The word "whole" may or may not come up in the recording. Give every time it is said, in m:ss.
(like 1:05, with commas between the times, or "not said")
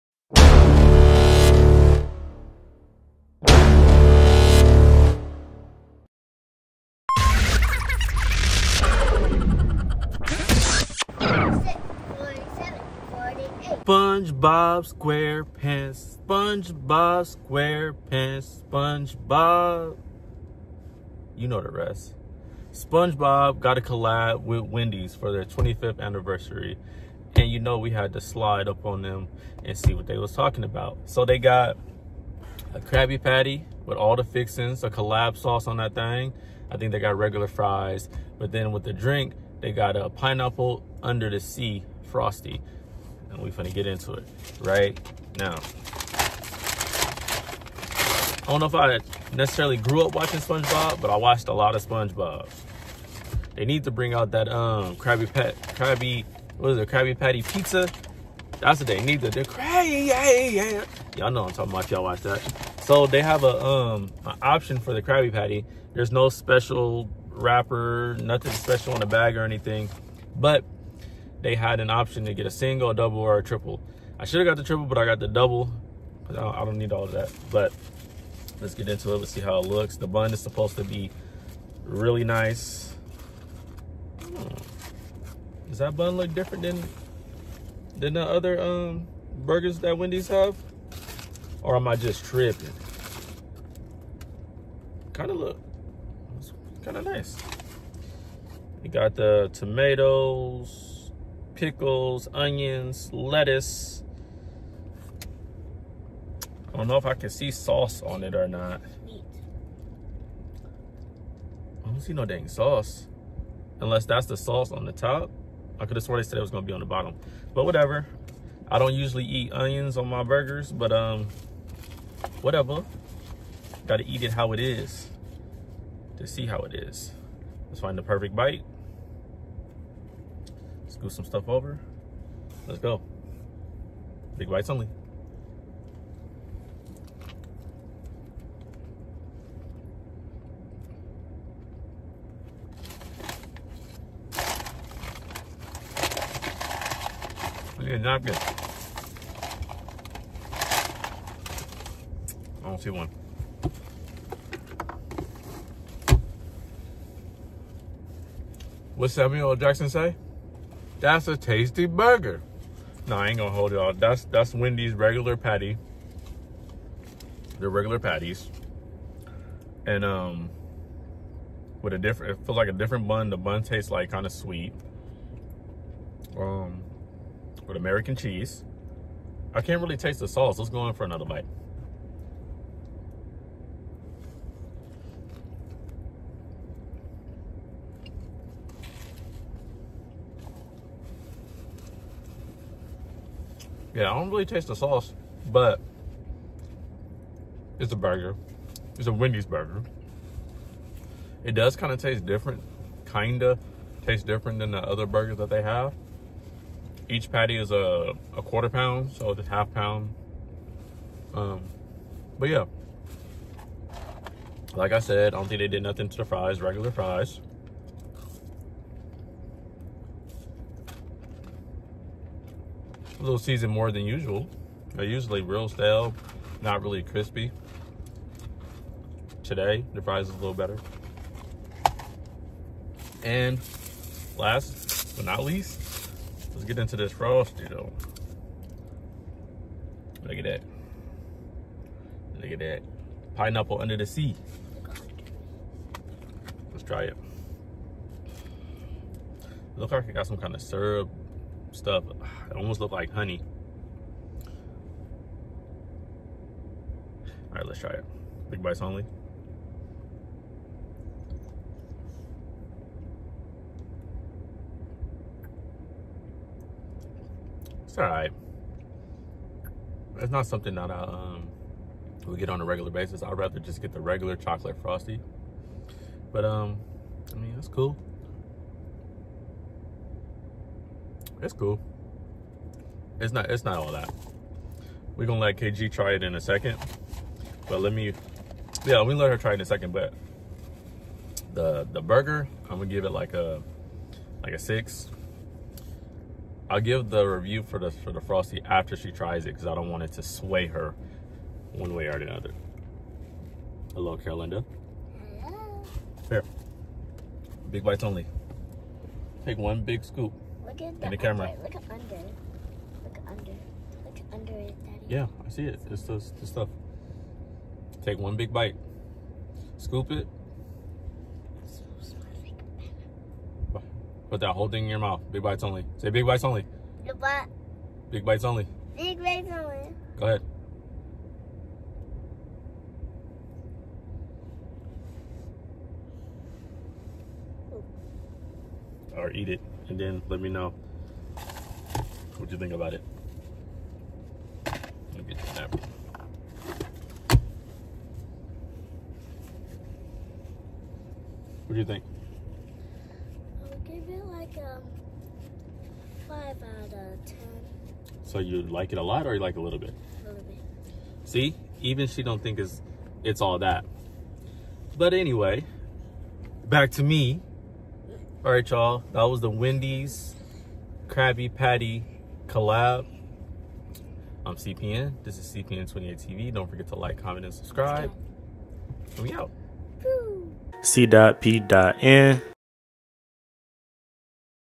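5:24.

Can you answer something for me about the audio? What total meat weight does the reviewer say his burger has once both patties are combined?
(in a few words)
Half pound.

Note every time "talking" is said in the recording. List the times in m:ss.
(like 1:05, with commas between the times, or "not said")
0:30, 1:01.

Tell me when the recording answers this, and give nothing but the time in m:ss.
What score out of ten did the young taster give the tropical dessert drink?
5:56.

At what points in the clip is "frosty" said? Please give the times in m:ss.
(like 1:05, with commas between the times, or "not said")
0:42, 3:57, 4:34, 4:58.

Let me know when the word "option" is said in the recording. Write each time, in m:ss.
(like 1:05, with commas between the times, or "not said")
1:04, 1:11.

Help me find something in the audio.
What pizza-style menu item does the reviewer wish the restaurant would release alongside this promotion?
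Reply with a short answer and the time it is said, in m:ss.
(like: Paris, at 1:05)
Krabby Patty pizza, at 0:56.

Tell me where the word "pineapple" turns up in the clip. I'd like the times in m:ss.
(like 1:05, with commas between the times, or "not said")
0:40, 4:03.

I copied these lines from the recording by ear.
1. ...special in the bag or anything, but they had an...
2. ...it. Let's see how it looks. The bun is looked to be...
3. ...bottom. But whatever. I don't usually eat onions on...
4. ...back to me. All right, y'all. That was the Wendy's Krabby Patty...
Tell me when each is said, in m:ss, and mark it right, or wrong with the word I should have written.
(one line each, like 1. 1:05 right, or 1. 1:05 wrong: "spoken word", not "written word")
1. 1:08 right
2. 1:19 wrong: "supposed", not "looked"
3. 1:56 right
4. 6:06 right.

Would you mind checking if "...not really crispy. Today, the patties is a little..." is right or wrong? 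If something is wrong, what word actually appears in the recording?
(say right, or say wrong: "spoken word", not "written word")
wrong: "fries", not "patties".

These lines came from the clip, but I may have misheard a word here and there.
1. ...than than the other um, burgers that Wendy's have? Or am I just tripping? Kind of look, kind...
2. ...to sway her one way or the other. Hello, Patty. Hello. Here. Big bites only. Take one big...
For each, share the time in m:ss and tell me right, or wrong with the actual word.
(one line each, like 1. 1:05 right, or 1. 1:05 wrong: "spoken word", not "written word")
1. 1:26 right
2. 5:00 wrong: "Carolinda", not "Patty".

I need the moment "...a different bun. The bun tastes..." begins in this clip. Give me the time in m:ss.
2:52.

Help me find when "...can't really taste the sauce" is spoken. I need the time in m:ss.
2:59.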